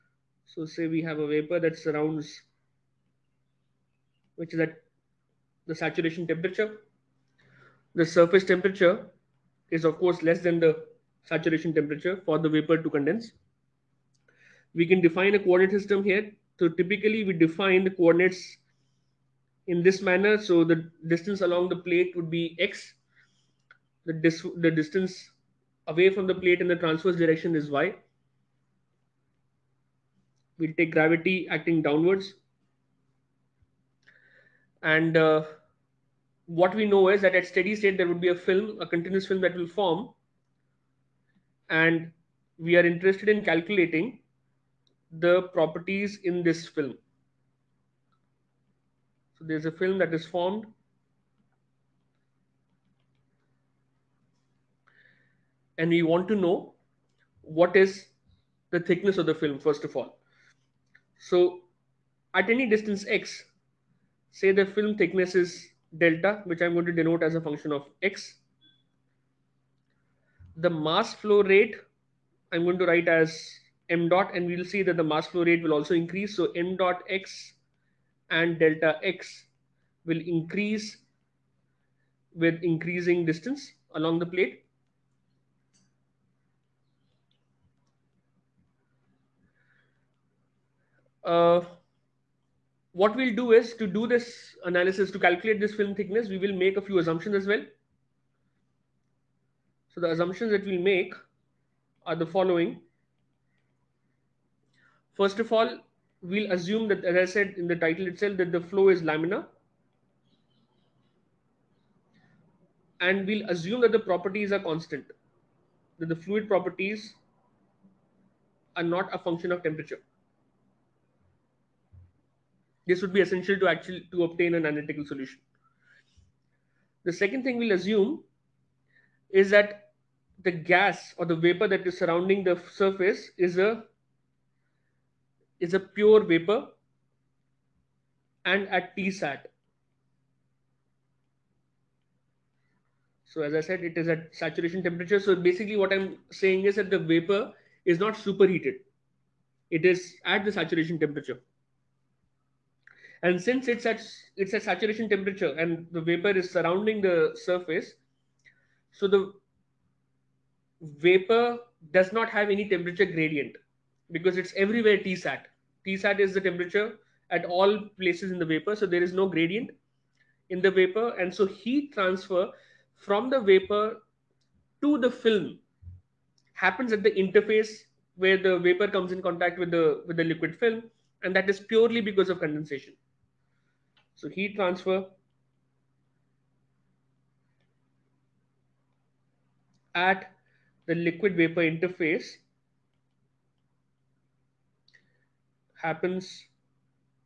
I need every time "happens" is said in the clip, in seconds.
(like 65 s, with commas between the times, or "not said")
176 s, 195 s.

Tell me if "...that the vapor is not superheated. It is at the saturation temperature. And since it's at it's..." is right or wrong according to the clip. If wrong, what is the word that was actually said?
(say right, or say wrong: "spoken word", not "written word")
right.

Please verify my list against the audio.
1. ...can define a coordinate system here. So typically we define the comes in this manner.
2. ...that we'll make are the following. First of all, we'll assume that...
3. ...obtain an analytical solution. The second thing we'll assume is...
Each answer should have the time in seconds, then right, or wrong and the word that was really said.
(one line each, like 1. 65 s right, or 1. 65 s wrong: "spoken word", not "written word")
1. 14 s wrong: "coordinates", not "comes"
2. 100 s right
3. 124 s right.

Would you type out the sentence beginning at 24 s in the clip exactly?
The, dis the distance away from the plate in the transverse direction is y.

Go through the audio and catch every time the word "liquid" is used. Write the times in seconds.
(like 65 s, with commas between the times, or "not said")
180 s, 190 s.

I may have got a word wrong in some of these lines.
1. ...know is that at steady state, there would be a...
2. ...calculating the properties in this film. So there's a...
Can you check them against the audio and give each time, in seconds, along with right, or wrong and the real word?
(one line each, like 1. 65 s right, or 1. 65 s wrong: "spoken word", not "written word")
1. 36 s right
2. 43 s right.